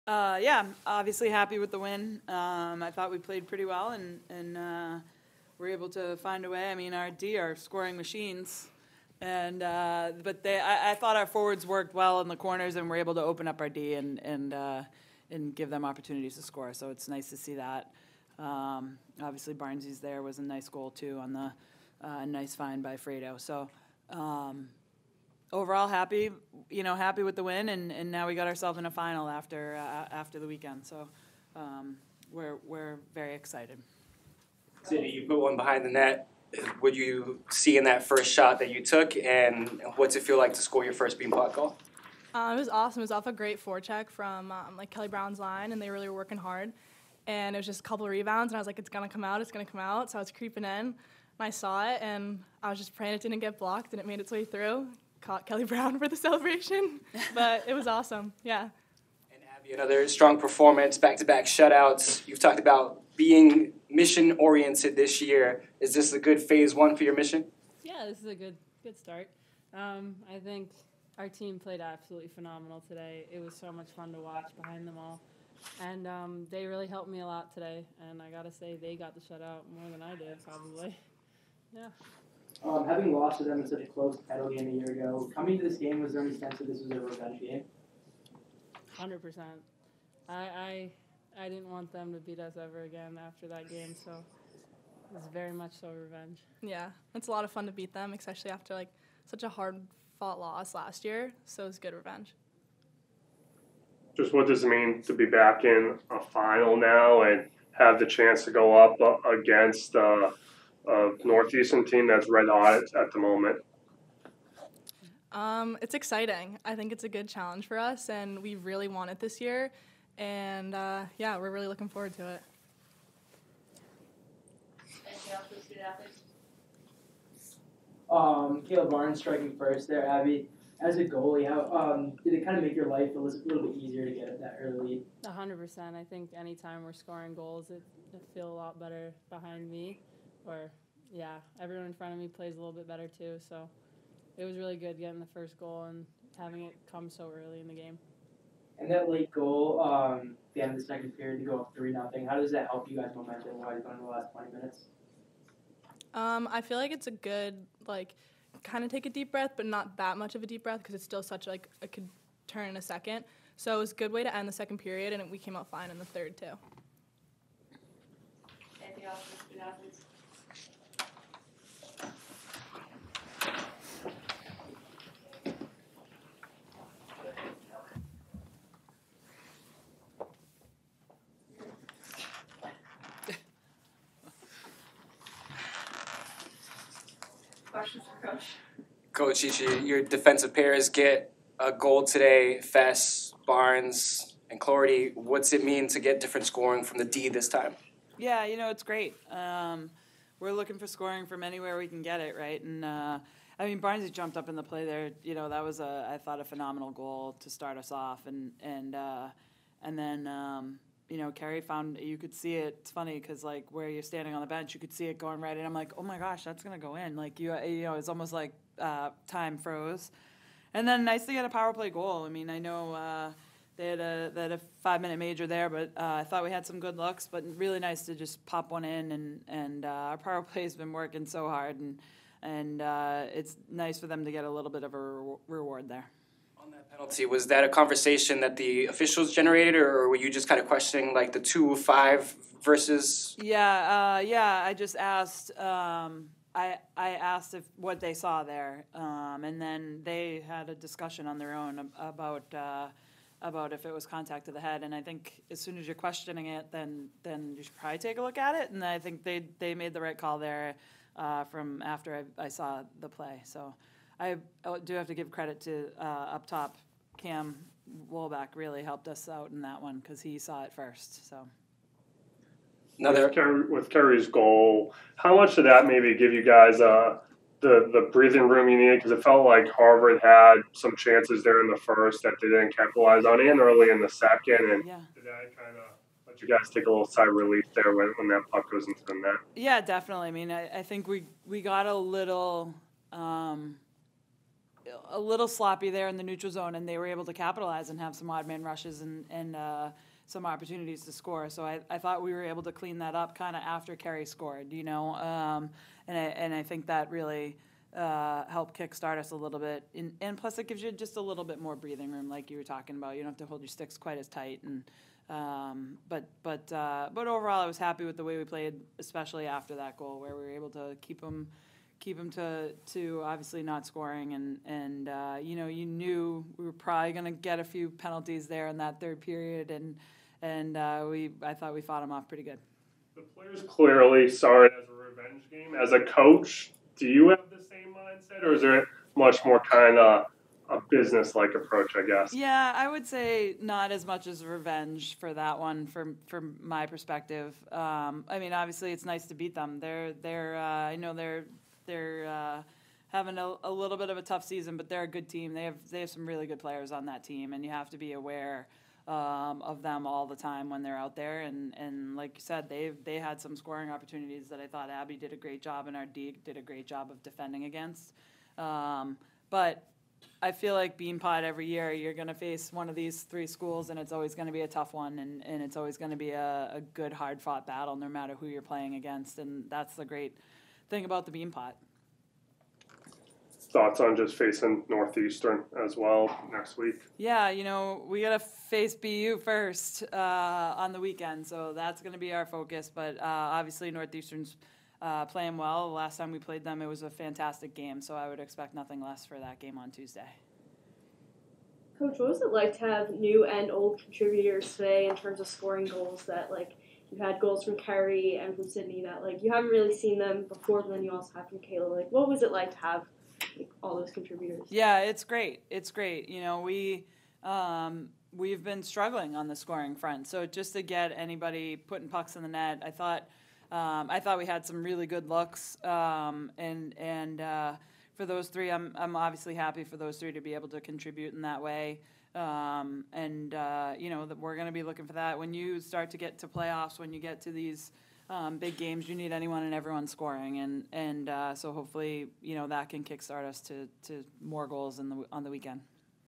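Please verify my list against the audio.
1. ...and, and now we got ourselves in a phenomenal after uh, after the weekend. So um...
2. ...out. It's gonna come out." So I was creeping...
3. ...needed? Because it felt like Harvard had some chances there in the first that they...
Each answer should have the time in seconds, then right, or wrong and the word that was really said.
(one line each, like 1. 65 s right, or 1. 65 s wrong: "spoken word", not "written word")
1. 27 s wrong: "final", not "phenomenal"
2. 49 s right
3. 278 s right.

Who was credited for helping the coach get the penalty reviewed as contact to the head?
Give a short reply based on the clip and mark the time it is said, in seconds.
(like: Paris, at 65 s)
Cam Wolback, at 267 s.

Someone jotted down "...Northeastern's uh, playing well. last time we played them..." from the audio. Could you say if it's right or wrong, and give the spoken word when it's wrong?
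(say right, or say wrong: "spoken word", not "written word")
right.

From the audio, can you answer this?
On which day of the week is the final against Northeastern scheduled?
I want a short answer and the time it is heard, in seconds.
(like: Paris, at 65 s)
Tuesday, at 399 s.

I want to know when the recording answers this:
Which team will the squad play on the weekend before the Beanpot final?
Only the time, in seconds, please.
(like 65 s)
388 s.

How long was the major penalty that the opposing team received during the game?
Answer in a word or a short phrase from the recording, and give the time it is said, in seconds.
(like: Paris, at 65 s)
5 minutes, at 224 s.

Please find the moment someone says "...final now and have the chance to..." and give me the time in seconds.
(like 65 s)
106 s.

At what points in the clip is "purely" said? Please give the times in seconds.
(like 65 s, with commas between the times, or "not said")
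not said.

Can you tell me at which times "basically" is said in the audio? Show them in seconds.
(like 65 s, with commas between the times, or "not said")
not said.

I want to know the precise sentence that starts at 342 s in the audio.
Yeah, I would say not as much as revenge for that one, from from my perspective.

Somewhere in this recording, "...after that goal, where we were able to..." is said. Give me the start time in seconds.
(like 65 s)
319 s.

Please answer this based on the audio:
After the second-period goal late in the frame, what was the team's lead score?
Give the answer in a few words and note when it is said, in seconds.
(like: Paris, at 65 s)
3-0, at 151 s.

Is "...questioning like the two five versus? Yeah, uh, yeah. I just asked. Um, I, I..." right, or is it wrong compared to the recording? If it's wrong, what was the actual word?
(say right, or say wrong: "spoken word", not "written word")
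right.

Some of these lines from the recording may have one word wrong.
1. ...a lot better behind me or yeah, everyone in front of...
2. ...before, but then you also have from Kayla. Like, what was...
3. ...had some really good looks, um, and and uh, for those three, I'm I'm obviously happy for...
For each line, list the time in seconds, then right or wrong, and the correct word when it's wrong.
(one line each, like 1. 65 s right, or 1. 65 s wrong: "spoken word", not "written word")
1. 138 s right
2. 410 s right
3. 424 s right.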